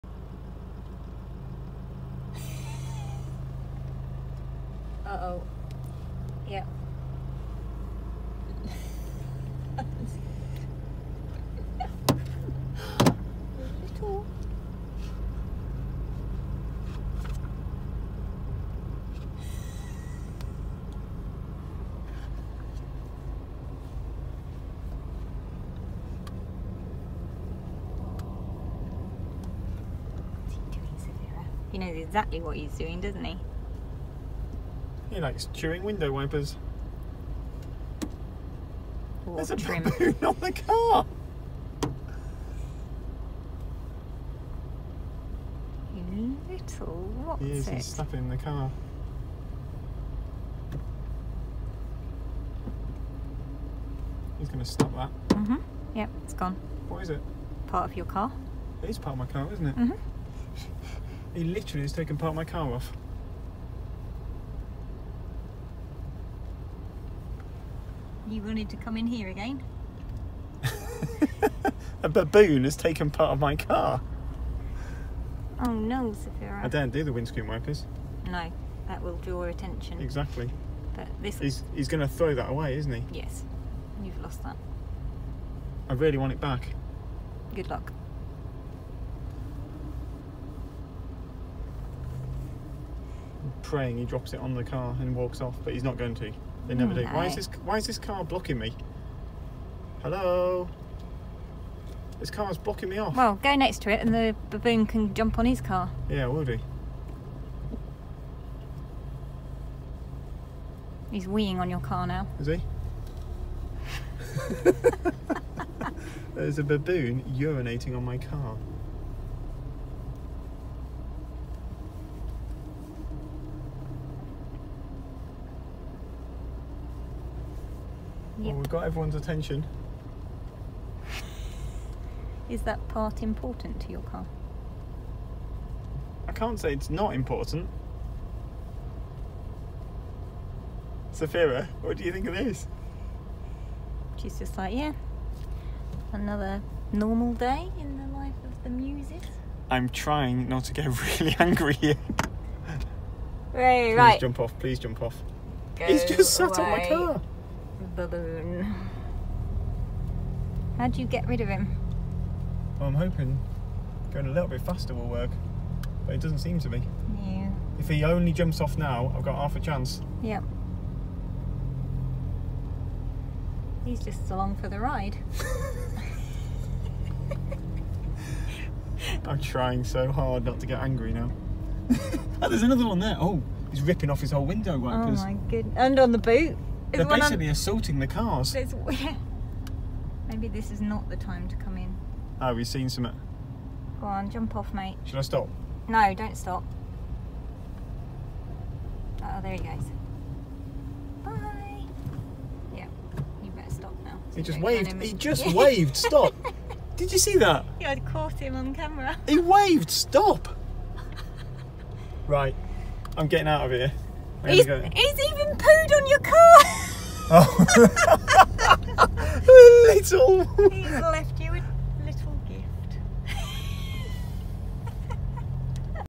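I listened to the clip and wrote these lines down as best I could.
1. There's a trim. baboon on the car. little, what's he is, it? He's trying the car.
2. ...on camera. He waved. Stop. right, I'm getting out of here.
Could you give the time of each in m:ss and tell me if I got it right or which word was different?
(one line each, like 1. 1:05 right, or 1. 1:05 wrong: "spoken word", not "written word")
1. 0:39 wrong: "stuffing", not "trying"
2. 3:28 right.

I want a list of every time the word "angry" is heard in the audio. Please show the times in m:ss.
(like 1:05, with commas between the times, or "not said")
2:31, 3:00.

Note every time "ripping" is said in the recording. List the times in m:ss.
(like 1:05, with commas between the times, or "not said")
3:03.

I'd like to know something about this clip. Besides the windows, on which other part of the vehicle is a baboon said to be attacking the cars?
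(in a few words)
The boot.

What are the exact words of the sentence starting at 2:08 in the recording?
Well, oh, we've got everyone's attention.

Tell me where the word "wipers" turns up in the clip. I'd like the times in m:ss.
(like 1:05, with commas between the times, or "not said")
0:36, 1:17, 3:04.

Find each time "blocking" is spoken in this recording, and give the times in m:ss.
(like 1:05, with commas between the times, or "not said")
1:38, 1:42.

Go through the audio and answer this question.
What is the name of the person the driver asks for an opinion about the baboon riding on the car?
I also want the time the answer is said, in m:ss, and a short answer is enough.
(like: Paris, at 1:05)
Safira, at 2:21.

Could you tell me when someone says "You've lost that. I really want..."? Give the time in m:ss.
1:24.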